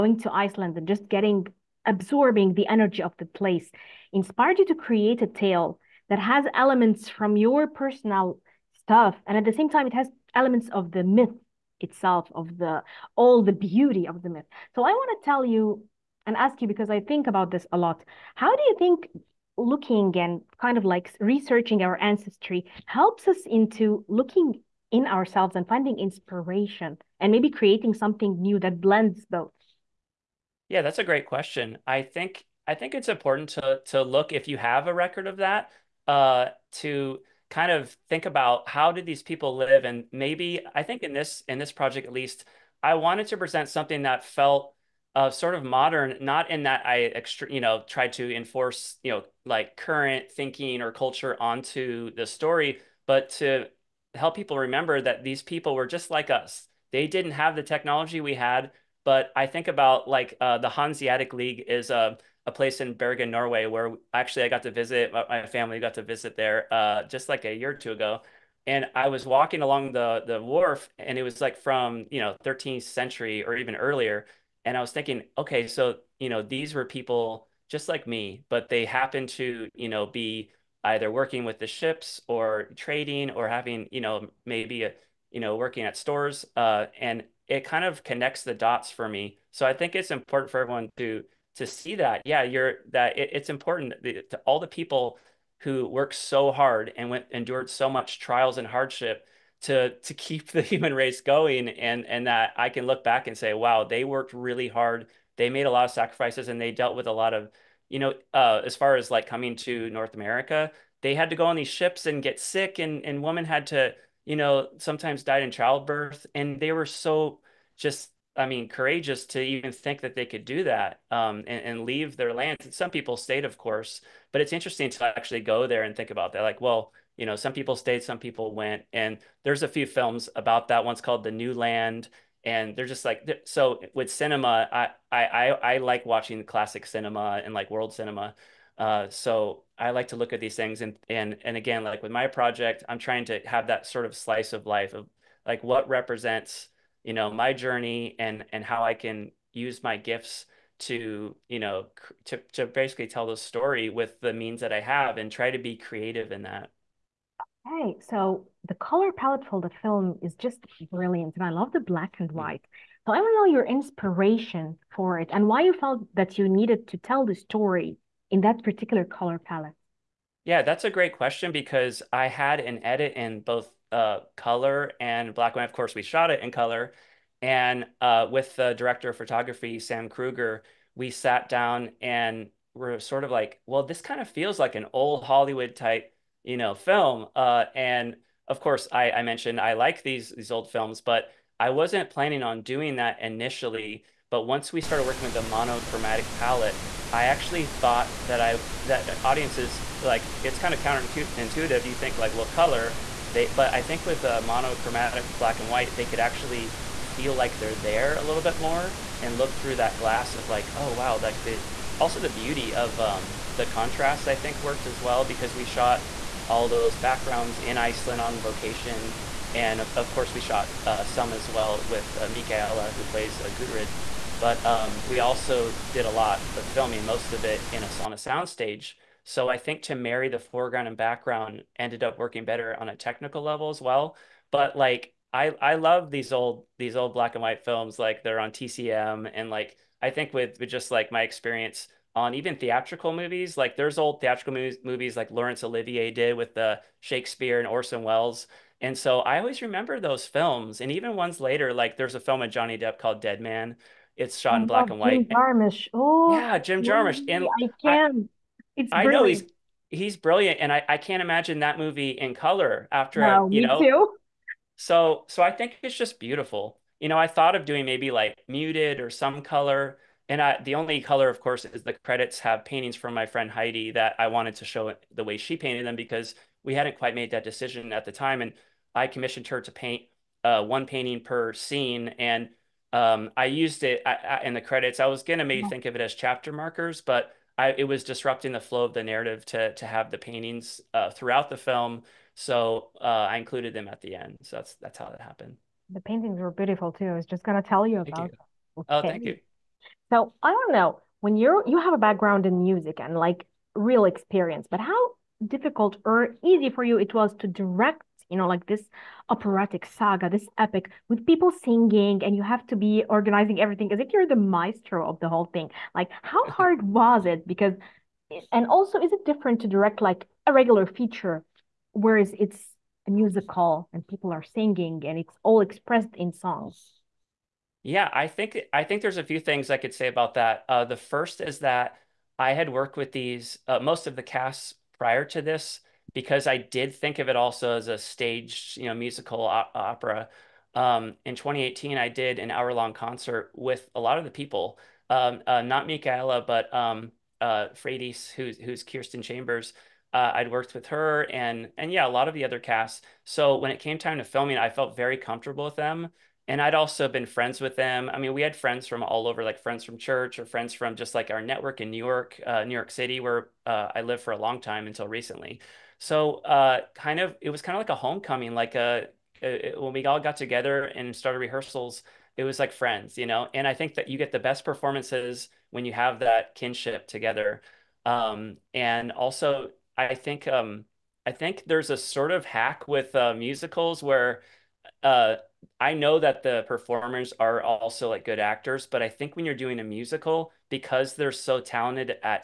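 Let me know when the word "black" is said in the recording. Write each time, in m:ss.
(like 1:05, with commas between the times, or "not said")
2:41, 2:55, 3:25, 3:57, 4:14.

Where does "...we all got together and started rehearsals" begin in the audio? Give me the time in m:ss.
6:09.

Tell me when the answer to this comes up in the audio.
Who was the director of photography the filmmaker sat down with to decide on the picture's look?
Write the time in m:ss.
2:59.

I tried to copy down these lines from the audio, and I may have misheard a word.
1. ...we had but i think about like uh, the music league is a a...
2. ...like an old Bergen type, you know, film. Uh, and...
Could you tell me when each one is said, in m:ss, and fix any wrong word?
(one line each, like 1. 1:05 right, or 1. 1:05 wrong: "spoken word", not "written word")
1. 0:58 wrong: "hanseatic", not "music"
2. 3:04 wrong: "Hollywood", not "Bergen".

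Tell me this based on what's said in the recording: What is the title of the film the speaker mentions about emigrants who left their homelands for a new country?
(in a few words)
The New Land.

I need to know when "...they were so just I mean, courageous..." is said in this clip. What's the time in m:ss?
1:56.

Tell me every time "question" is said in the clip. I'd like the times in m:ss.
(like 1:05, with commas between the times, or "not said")
0:31, 2:51.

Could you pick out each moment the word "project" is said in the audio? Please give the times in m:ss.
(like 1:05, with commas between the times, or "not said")
0:41, 2:22.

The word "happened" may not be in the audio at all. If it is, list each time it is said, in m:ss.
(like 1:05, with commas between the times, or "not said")
1:18, 4:55.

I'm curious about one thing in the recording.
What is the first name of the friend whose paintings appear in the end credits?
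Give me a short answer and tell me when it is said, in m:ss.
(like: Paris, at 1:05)
Heidi, at 4:33.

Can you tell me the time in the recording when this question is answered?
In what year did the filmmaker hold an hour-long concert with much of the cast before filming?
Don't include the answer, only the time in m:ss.
5:41.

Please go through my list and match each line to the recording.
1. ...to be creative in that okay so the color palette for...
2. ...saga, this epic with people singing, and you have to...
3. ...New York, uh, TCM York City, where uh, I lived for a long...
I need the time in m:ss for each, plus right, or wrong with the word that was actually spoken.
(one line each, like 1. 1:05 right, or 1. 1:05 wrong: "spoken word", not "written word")
1. 2:35 right
2. 5:09 right
3. 6:01 wrong: "New", not "TCM".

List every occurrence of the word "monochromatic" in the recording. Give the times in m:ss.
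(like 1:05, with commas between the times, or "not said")
3:15, 3:24.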